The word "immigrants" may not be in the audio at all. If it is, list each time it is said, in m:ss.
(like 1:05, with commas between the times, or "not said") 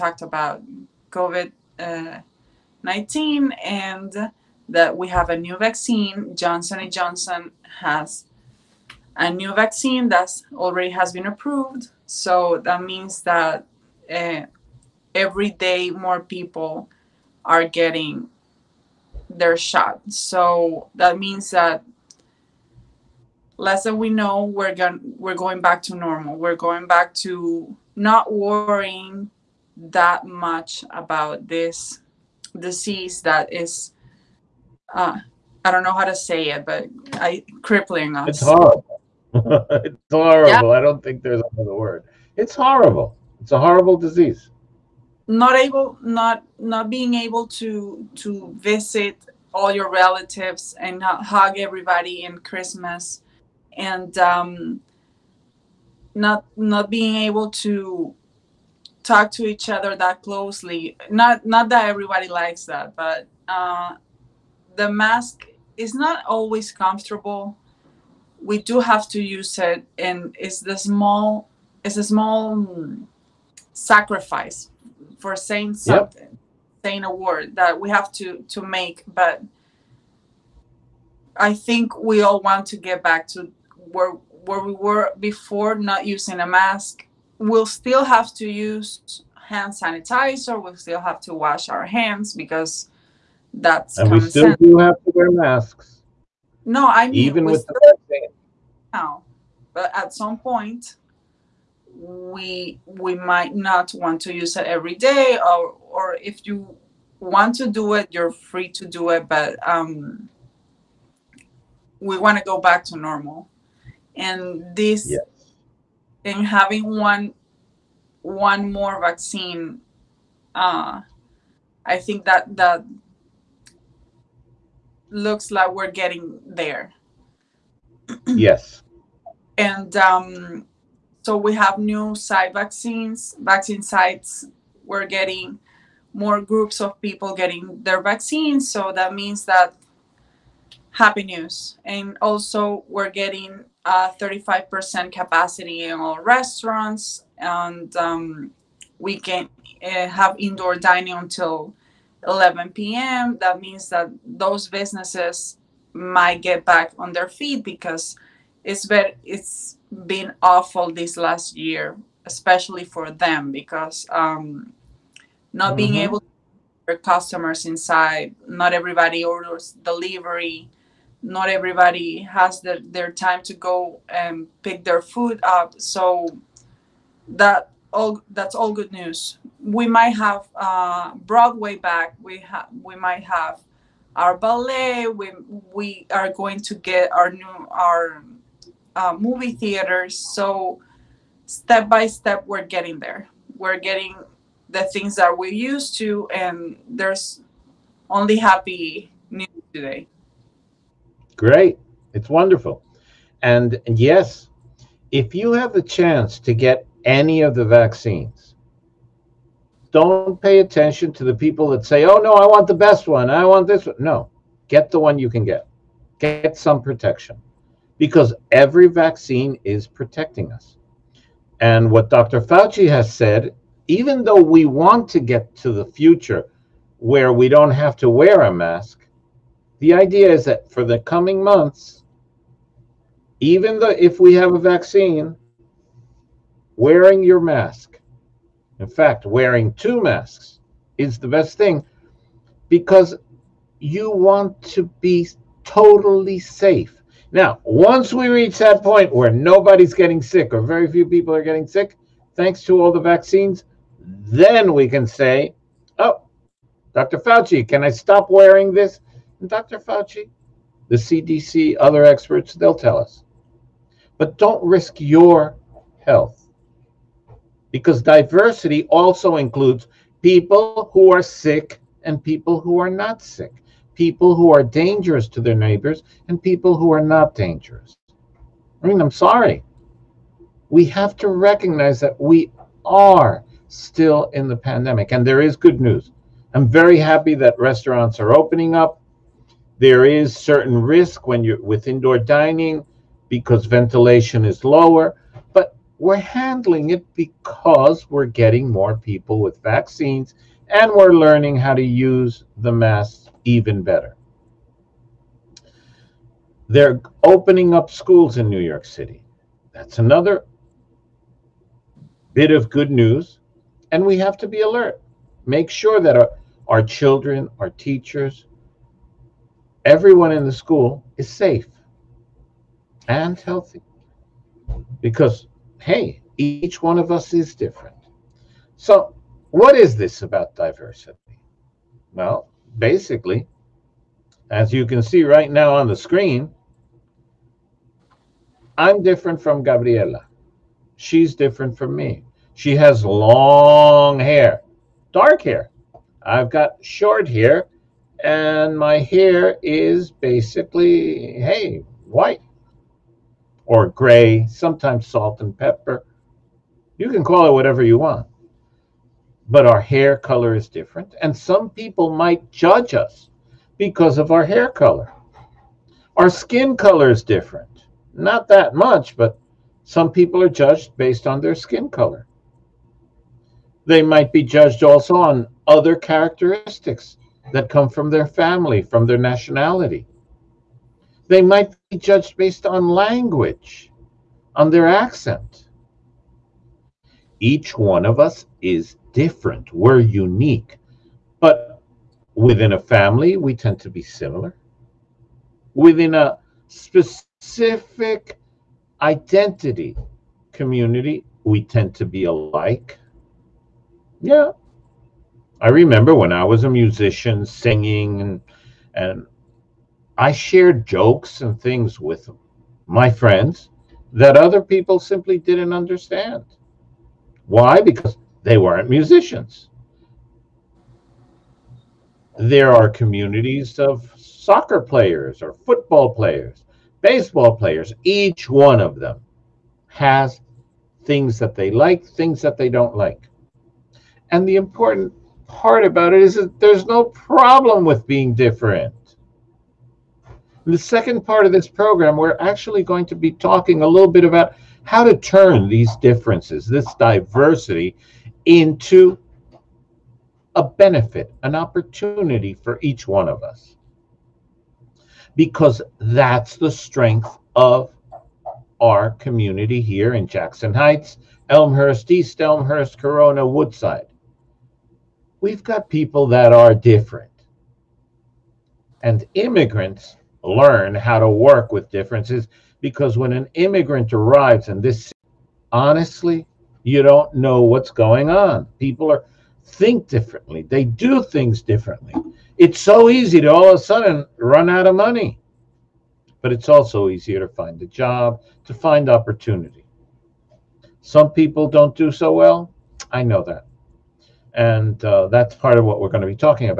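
7:49, 7:53.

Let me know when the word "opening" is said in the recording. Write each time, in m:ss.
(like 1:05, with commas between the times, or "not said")
4:48, 5:07.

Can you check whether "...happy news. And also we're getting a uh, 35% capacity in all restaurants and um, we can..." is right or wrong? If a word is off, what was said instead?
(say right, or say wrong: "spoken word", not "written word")
right.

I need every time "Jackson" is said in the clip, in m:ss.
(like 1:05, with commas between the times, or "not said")
7:40.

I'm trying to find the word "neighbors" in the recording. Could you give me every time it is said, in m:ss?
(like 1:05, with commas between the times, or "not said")
4:35.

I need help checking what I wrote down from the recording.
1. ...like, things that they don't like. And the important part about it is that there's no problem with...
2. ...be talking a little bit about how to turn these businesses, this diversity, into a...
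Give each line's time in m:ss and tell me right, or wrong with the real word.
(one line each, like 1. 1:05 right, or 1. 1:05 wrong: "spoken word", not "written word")
1. 7:11 right
2. 7:23 wrong: "differences", not "businesses".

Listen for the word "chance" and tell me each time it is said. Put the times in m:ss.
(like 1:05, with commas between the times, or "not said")
3:25.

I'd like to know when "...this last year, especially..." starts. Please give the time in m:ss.
2:40.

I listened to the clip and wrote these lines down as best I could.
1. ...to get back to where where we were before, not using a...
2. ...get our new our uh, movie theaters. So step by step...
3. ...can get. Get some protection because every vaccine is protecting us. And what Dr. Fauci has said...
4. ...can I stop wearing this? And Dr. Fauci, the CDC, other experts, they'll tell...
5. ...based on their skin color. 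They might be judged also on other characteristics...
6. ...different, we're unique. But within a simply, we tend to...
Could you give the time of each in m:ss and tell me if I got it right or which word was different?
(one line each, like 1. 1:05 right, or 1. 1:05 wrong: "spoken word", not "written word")
1. 1:22 right
2. 3:06 right
3. 3:35 right
4. 4:17 right
5. 6:10 right
6. 6:29 wrong: "family", not "simply".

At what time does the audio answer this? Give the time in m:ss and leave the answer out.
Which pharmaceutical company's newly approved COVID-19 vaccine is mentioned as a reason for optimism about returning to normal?
0:06.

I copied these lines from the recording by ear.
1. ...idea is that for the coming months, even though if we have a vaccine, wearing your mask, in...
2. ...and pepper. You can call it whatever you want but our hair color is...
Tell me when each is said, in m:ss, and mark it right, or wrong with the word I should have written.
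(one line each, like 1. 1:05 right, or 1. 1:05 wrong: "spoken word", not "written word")
1. 3:49 right
2. 5:55 right.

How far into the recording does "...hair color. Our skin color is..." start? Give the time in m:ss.
6:04.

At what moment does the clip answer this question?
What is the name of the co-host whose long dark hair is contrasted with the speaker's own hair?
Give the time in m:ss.
5:39.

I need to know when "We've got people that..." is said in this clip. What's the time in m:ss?
7:45.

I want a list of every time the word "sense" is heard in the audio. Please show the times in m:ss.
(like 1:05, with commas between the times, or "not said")
1:34.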